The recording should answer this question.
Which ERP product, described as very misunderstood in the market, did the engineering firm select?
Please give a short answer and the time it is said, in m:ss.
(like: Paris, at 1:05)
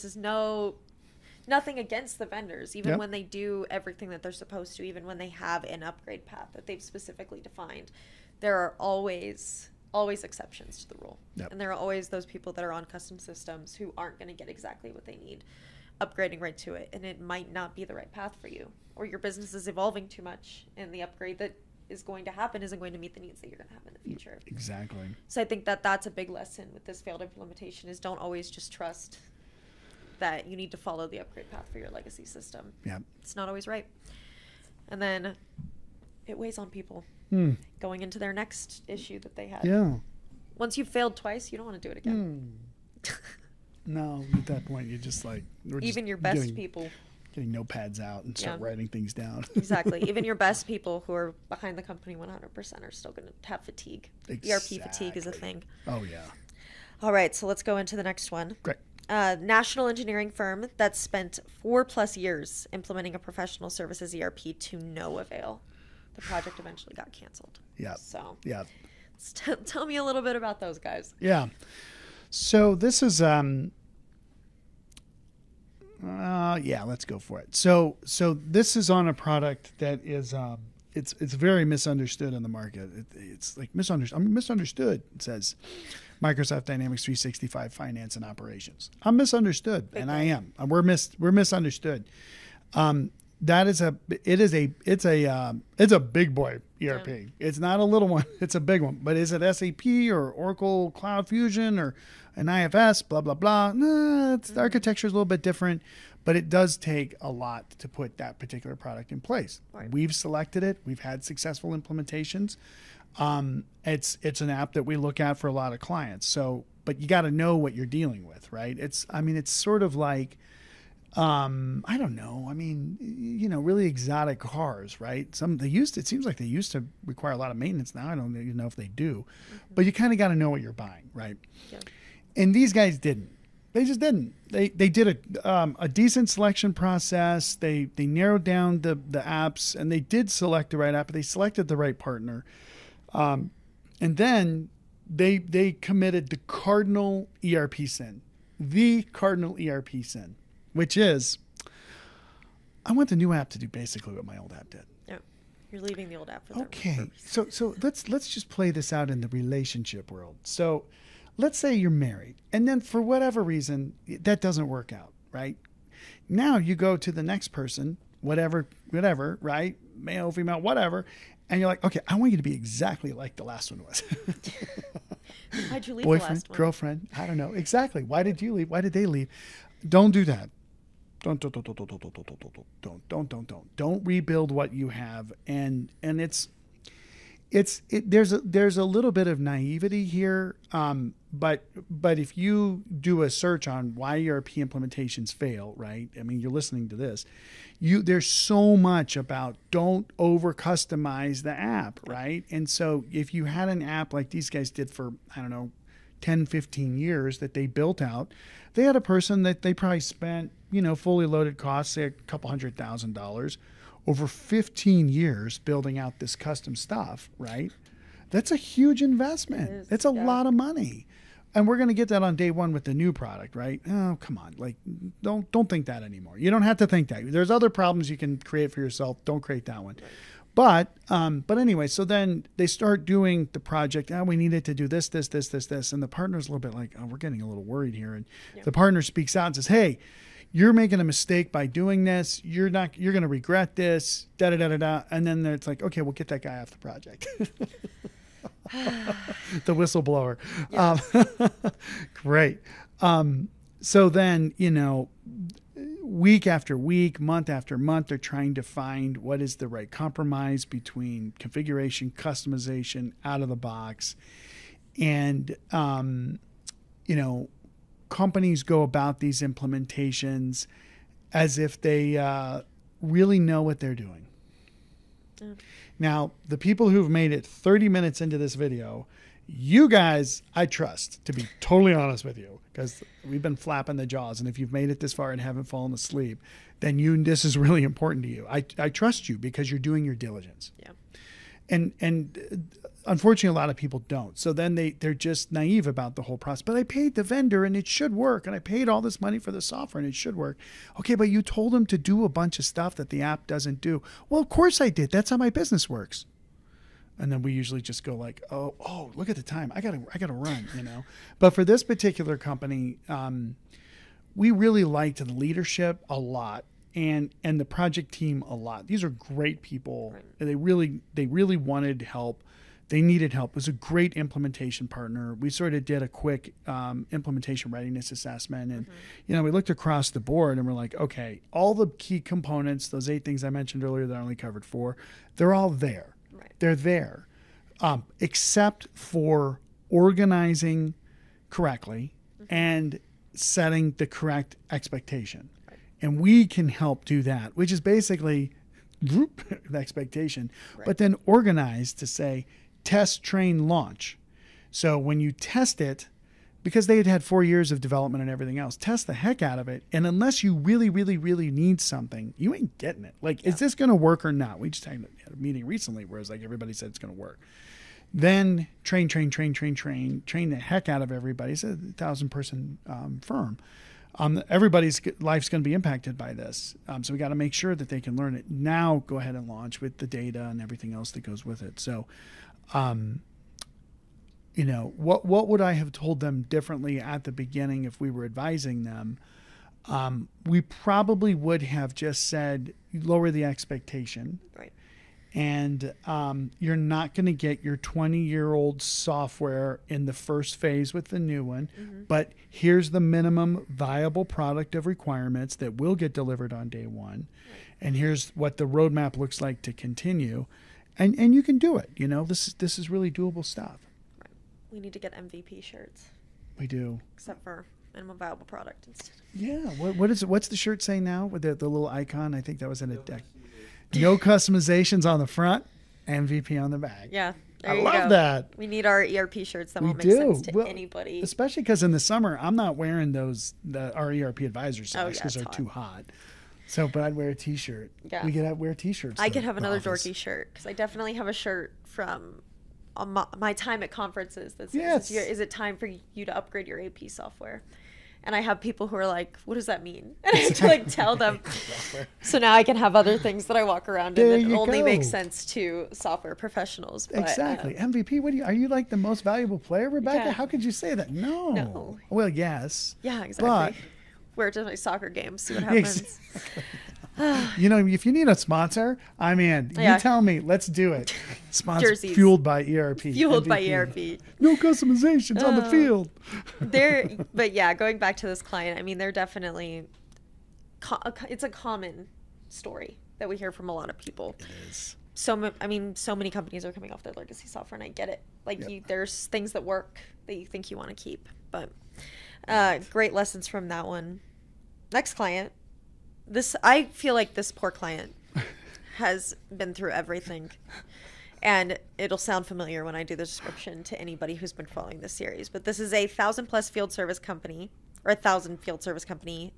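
Microsoft Dynamics 365 Finance and Operations, at 1:26.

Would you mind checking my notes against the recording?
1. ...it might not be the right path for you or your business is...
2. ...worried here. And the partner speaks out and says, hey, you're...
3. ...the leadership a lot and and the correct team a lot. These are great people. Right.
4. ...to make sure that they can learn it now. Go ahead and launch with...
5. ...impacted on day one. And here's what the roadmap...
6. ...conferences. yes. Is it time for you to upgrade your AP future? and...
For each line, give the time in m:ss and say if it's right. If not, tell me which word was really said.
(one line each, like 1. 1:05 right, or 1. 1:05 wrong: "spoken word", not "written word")
1. 0:17 right
2. 3:57 right
3. 5:15 wrong: "project", not "correct"
4. 6:17 right
5. 6:46 wrong: "delivered", not "impacted"
6. 7:23 wrong: "software", not "future".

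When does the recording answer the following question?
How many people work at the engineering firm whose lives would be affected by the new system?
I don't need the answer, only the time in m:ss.
6:11.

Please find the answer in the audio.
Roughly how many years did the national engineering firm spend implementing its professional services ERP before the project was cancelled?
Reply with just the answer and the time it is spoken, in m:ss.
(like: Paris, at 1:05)
4 plus years, at 1:01.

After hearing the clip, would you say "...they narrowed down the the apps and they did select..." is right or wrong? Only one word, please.
right.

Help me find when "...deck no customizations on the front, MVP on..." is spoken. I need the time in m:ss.
7:02.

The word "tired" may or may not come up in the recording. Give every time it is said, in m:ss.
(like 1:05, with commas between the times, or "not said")
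not said.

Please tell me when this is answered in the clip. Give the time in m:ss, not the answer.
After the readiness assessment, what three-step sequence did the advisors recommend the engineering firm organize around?
5:52.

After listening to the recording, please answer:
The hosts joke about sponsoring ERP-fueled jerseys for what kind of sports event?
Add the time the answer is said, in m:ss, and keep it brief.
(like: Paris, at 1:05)
soccer game, at 7:44.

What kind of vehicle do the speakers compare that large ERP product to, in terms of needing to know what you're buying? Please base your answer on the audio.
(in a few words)
exotic cars.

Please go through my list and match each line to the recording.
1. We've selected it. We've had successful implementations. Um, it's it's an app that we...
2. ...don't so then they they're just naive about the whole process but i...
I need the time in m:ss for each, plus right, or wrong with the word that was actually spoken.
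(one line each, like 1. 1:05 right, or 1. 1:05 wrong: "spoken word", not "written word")
1. 1:49 right
2. 4:54 right.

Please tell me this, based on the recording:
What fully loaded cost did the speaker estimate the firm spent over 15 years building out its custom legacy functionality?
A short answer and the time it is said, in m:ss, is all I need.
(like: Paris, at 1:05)
a couple hundred thousand dollars, at 3:32.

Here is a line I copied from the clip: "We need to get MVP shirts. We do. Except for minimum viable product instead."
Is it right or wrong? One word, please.
right.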